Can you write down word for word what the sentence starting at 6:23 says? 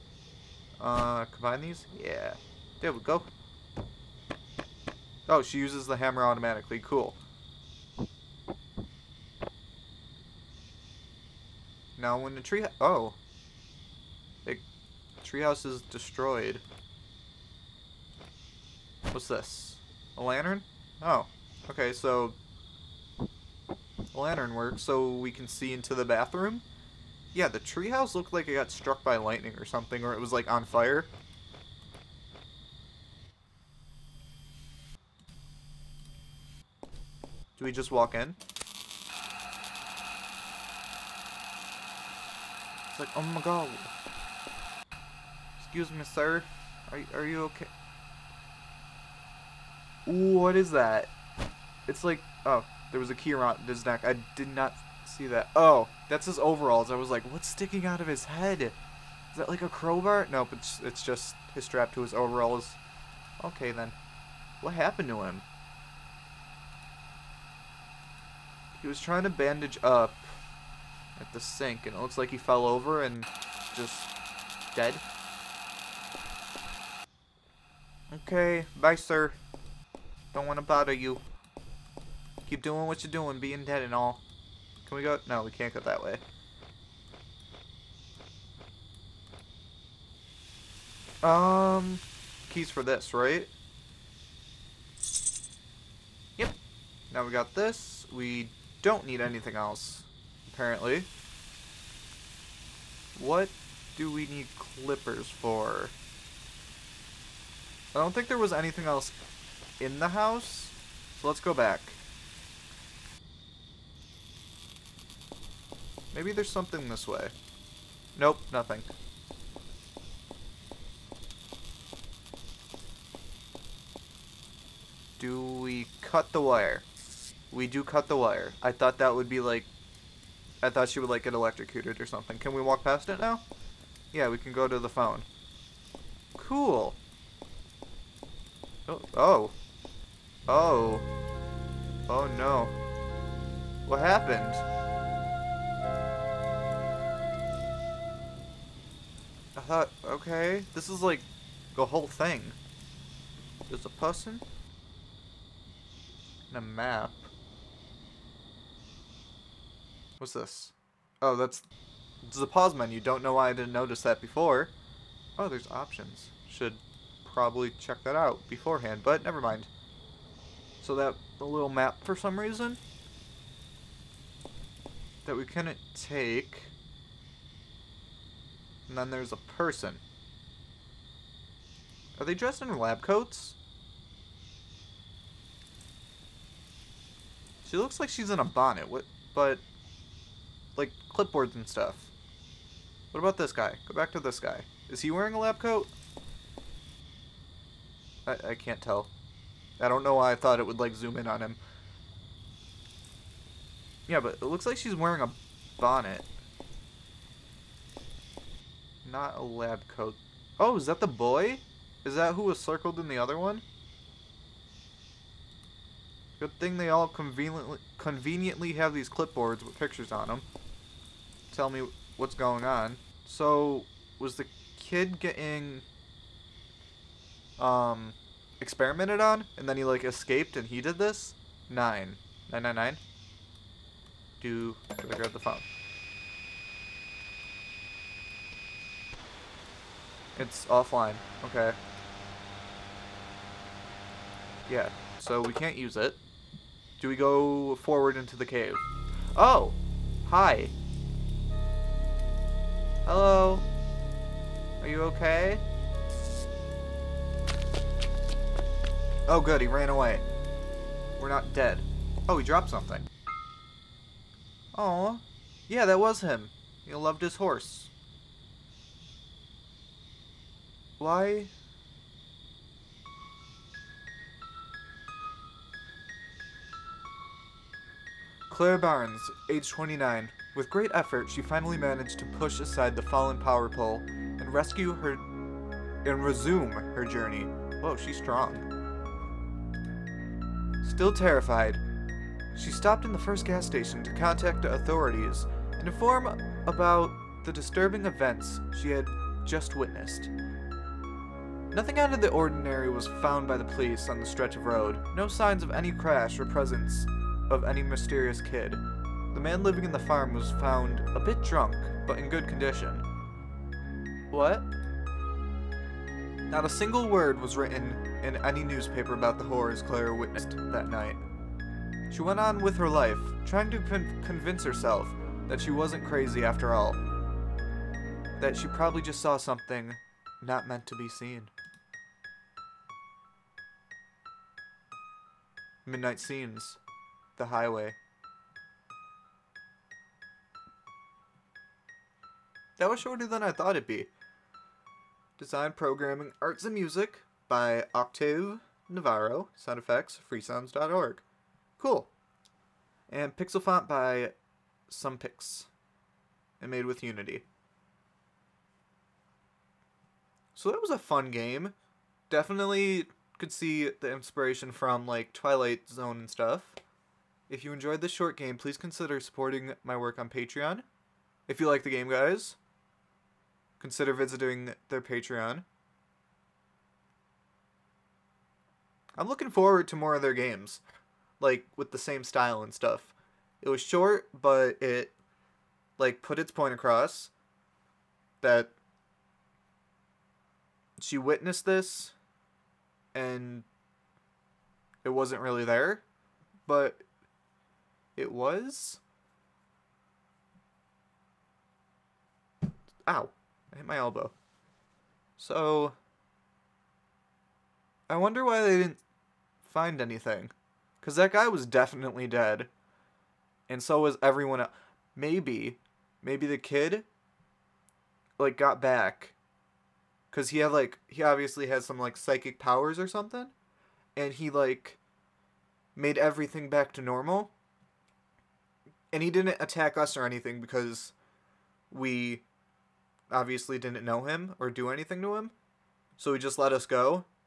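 It was short, but it like put its point across that she witnessed this and it wasn't really there, but it was.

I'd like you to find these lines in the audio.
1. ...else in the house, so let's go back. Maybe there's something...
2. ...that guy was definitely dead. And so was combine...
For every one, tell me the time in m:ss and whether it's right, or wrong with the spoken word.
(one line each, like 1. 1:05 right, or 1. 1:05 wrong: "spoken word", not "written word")
1. 1:48 right
2. 6:51 wrong: "everyone", not "combine".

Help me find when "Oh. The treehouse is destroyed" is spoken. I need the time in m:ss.
0:12.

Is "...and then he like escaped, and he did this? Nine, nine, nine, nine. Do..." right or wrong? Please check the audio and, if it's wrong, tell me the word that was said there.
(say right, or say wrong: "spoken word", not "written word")
right.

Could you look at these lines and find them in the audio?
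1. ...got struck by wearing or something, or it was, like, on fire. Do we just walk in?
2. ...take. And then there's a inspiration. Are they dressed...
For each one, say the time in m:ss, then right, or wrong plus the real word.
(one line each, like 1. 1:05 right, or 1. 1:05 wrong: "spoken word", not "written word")
1. 0:28 wrong: "lightning", not "wearing"
2. 2:56 wrong: "person", not "inspiration".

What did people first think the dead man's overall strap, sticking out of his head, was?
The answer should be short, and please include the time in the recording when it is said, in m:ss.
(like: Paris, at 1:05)
A crowbar, at 0:59.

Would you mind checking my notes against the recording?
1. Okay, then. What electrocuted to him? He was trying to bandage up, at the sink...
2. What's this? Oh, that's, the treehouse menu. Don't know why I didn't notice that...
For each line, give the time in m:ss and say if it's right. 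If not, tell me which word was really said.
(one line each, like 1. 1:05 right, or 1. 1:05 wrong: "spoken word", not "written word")
1. 1:03 wrong: "happened", not "electrocuted"
2. 2:40 wrong: "pause", not "treehouse".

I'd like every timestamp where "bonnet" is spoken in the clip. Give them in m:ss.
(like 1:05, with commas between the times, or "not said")
3:08, 3:25.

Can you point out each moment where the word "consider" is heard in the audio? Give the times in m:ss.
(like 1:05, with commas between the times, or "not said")
6:08, 6:13.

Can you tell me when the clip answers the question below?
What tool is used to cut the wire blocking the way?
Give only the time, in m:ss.
1:44.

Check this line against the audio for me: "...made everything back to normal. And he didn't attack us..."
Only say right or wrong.
right.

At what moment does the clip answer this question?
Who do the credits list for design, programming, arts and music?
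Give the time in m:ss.
5:47.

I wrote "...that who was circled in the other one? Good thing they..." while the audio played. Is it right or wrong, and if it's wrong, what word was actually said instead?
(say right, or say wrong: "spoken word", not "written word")
right.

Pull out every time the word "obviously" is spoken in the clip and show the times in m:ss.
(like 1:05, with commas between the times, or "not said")
7:01, 7:13.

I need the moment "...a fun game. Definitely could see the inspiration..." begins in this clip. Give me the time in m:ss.
6:00.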